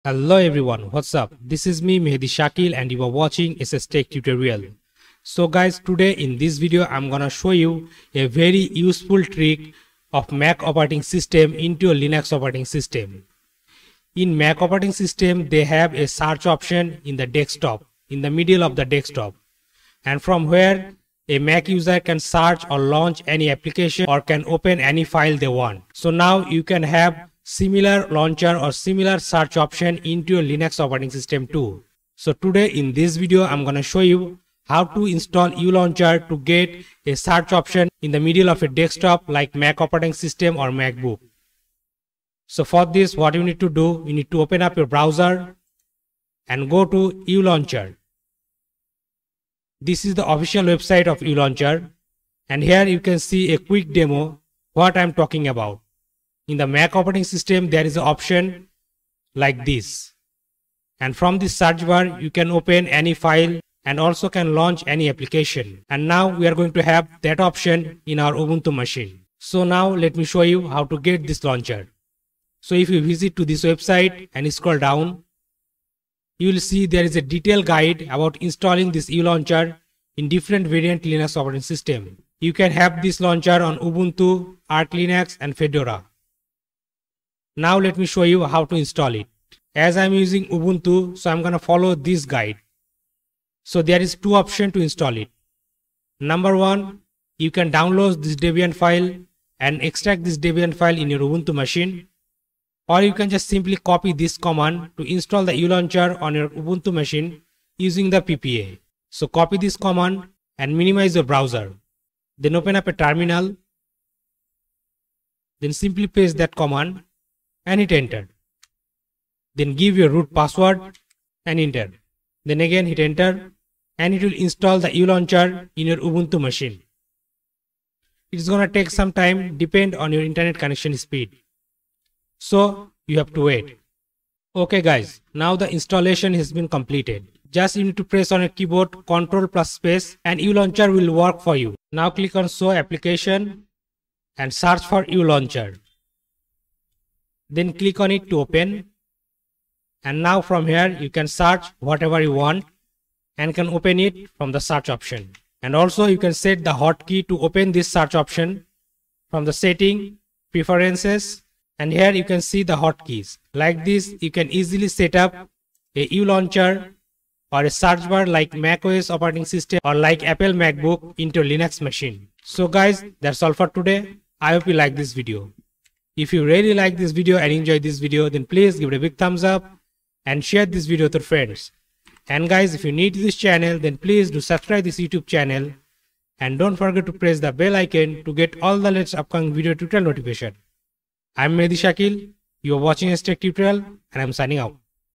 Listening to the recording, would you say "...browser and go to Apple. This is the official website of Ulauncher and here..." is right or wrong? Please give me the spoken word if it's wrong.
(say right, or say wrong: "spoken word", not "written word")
wrong: "Ulauncher", not "Apple".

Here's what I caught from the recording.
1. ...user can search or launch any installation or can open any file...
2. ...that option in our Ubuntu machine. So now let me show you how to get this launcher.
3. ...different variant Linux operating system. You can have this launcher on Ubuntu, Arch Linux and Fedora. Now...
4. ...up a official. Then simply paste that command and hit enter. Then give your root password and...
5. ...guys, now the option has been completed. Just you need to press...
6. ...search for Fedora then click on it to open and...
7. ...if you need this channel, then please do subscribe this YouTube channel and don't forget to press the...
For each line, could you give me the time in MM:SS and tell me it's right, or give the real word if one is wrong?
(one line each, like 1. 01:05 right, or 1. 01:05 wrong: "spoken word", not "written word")
1. 00:21 wrong: "application", not "installation"
2. 01:07 right
3. 01:20 right
4. 01:52 wrong: "terminal", not "official"
5. 02:14 wrong: "installation", not "option"
6. 02:24 wrong: "Ulauncher", not "Fedora"
7. 03:02 right.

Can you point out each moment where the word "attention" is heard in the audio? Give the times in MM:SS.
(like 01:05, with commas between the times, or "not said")
not said.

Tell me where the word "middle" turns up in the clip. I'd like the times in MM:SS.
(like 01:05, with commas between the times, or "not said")
00:18, 00:38.